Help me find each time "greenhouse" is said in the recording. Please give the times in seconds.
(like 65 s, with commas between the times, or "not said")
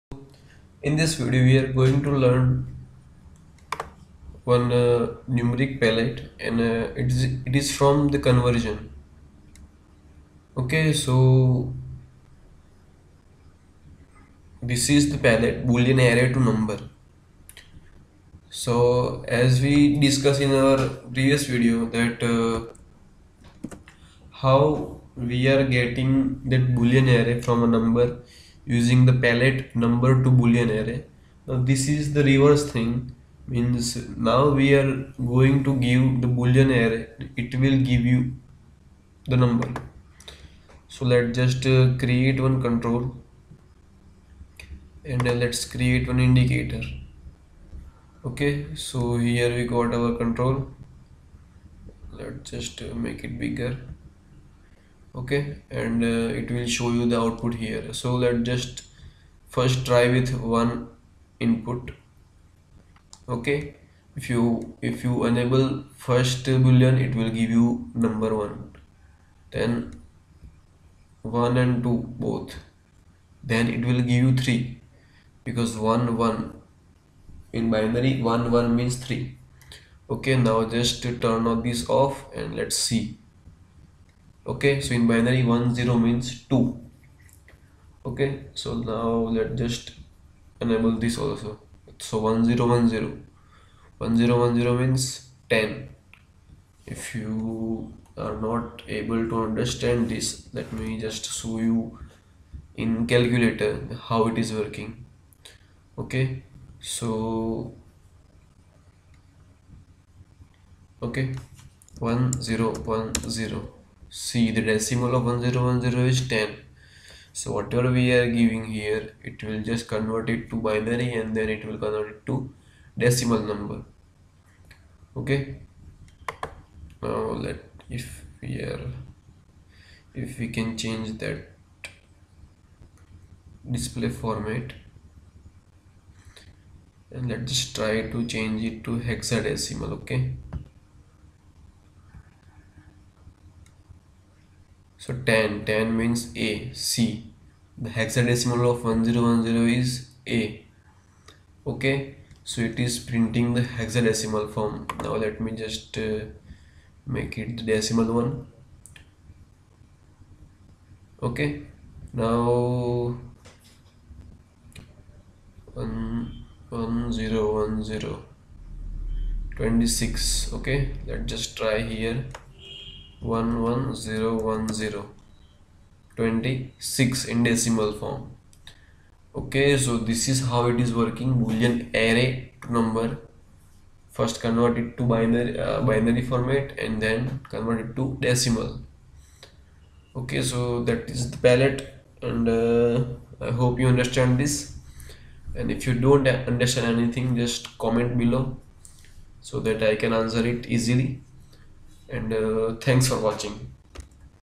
not said.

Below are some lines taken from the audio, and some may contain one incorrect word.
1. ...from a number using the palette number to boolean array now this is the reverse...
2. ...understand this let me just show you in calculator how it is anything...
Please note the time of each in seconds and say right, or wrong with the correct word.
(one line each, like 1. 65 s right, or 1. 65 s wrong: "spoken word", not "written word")
1. 27 s right
2. 99 s wrong: "working", not "anything".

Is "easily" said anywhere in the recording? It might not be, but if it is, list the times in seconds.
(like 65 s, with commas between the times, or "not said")
200 s.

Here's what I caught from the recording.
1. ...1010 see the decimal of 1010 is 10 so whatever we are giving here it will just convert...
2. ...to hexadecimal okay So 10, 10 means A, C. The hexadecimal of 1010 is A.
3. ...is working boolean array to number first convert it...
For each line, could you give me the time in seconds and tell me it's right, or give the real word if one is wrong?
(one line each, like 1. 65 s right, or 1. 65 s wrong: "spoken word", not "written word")
1. 112 s right
2. 138 s right
3. 180 s right.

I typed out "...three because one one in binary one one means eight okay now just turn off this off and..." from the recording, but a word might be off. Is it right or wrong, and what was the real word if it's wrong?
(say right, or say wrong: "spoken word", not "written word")
wrong: "three", not "eight".